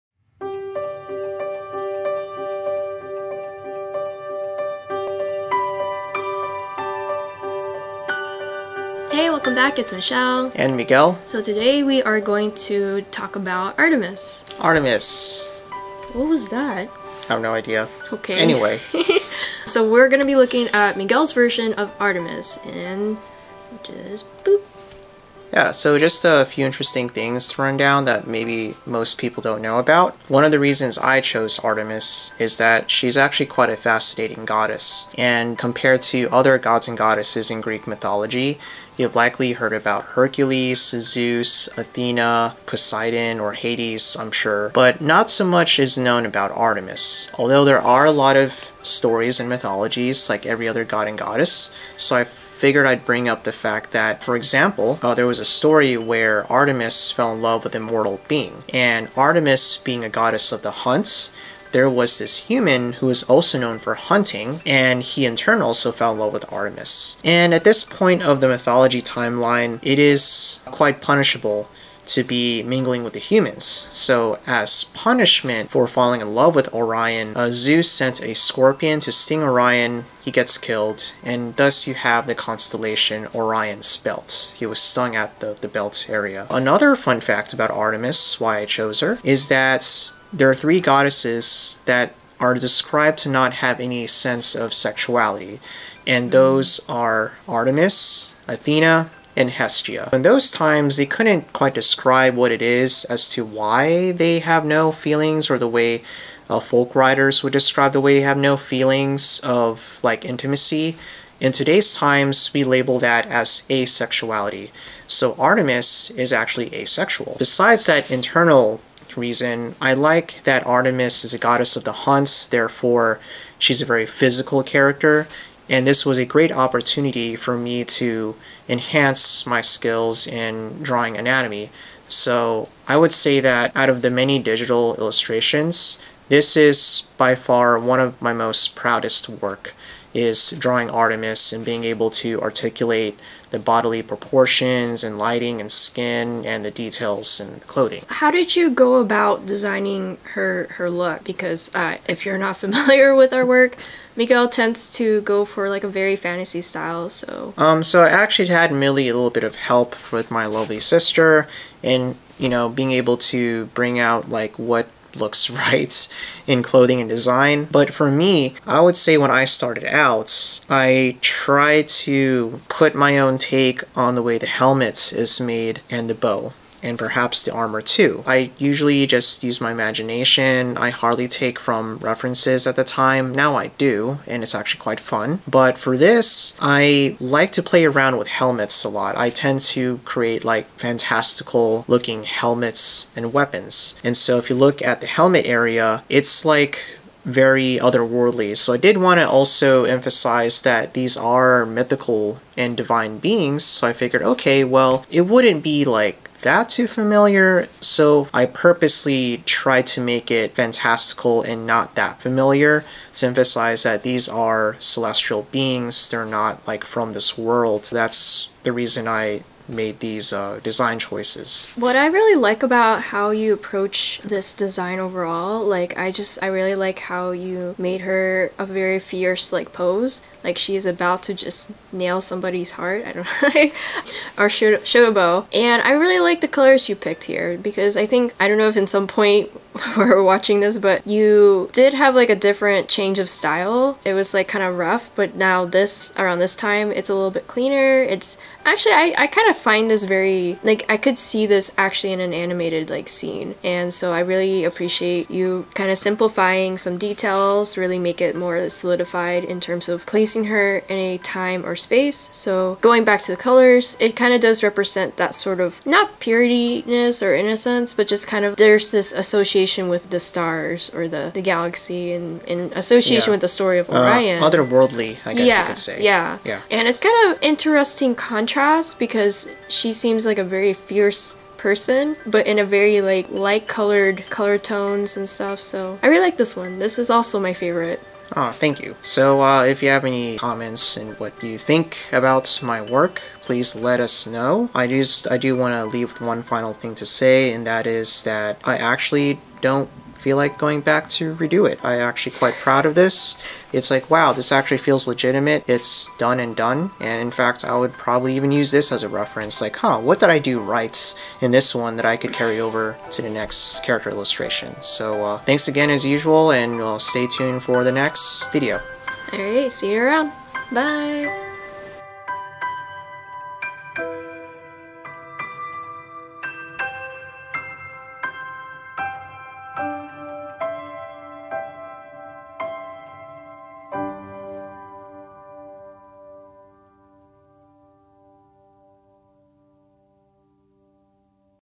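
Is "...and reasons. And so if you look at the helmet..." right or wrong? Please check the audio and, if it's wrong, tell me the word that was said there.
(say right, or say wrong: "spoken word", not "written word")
wrong: "weapons", not "reasons".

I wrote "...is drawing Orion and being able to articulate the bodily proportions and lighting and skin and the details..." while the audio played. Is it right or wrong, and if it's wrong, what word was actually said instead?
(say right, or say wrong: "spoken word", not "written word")
wrong: "Artemis", not "Orion".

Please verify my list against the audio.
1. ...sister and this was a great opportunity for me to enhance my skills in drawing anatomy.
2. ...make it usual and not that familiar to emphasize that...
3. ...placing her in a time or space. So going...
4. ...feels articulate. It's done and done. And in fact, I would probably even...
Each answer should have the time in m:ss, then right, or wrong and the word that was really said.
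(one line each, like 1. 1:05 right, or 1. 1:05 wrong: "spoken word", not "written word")
1. 2:04 wrong: "character", not "sister"
2. 3:30 wrong: "fantastical", not "usual"
3. 4:20 right
4. 5:04 wrong: "legitimate", not "articulate".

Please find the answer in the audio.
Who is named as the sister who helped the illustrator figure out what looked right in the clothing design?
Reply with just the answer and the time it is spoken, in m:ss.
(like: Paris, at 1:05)
Millie, at 2:38.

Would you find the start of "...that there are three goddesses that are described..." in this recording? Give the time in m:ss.
1:29.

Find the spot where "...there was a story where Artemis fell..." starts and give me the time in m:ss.
0:55.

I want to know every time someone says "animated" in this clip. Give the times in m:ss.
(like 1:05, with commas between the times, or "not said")
4:12.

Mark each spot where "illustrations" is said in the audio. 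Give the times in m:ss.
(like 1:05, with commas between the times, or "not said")
2:14, 5:14.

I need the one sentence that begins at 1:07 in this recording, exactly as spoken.
And at this point of the mythology timeline, it is quite punishable to be mingling with the humans.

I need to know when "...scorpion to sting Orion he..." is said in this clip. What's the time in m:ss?
1:18.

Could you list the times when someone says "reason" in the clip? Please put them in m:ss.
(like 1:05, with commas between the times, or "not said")
0:30, 1:59, 3:38.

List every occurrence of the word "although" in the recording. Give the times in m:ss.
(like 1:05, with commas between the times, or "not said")
0:47.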